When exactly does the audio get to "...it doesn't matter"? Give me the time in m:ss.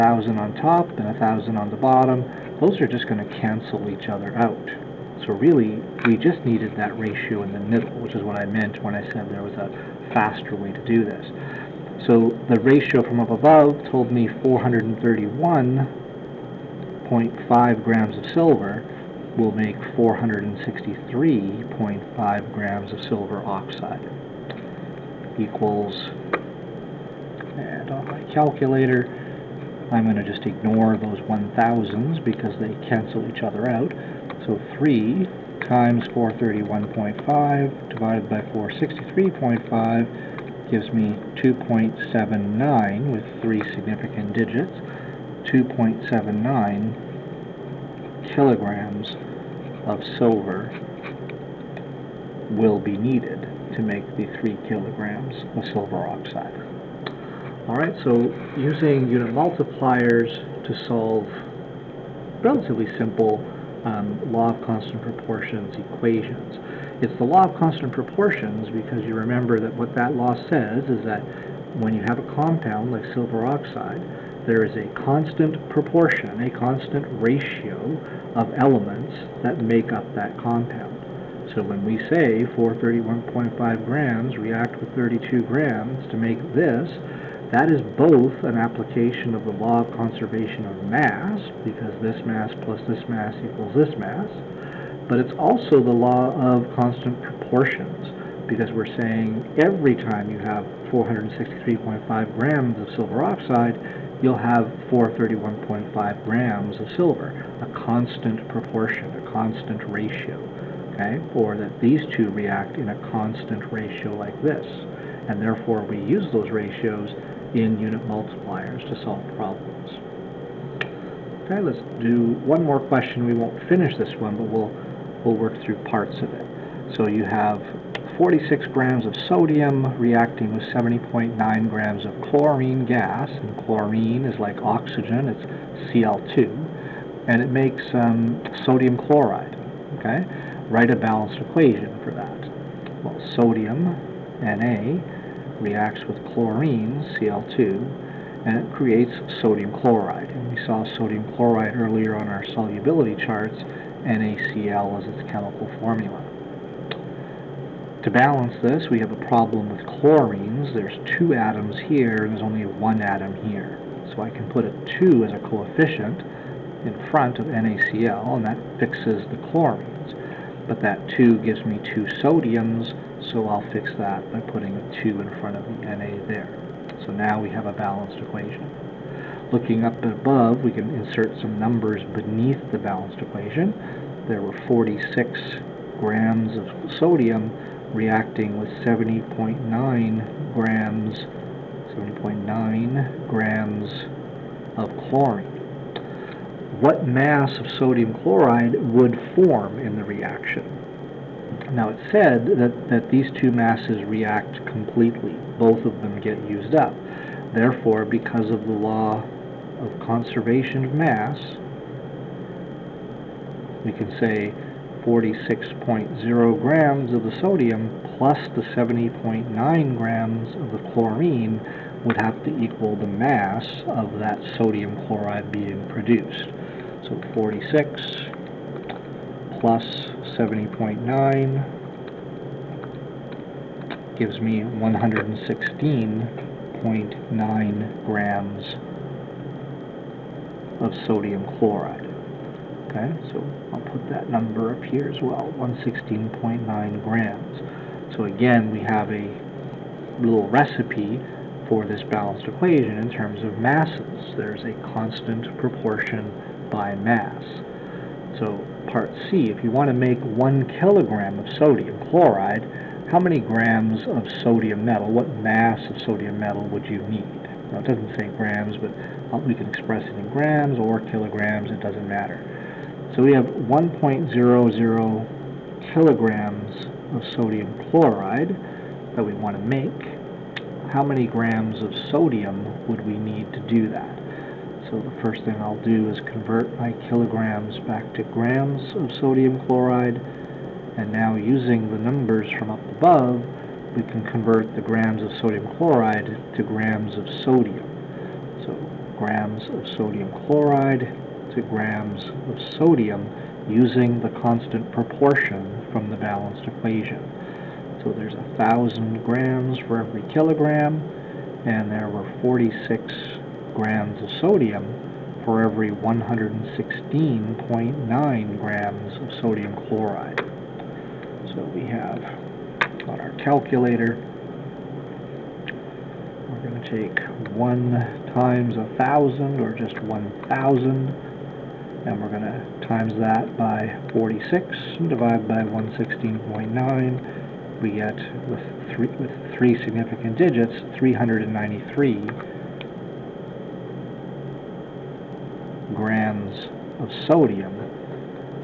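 4:31.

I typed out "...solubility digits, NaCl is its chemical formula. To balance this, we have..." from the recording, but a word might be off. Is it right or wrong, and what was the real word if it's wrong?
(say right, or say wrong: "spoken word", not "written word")
wrong: "charts", not "digits".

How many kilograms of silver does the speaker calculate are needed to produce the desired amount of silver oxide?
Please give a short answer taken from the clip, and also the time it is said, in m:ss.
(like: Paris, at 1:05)
2.79 kilograms, at 0:45.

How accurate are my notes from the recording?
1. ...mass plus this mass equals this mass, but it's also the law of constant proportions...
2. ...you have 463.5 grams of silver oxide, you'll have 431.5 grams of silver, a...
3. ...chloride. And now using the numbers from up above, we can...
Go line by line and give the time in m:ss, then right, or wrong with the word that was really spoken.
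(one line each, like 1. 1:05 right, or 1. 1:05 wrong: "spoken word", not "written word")
1. 1:32 right
2. 1:40 right
3. 4:49 right.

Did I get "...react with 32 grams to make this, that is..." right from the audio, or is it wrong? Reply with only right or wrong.
right.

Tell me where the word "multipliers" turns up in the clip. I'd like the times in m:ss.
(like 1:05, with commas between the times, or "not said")
0:59, 1:58.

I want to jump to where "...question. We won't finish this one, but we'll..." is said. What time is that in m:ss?
2:02.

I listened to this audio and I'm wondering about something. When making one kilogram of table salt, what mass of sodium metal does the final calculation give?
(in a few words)
393 grams.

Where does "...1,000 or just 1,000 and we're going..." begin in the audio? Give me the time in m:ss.
5:29.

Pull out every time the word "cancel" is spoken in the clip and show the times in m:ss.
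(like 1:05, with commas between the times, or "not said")
0:03, 0:32.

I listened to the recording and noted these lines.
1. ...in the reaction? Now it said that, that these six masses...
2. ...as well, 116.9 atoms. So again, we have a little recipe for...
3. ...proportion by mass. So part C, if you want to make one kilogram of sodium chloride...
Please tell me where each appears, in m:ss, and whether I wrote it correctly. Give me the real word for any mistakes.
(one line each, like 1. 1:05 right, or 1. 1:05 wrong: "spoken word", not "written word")
1. 3:19 wrong: "two", not "six"
2. 4:05 wrong: "grams", not "atoms"
3. 4:15 right.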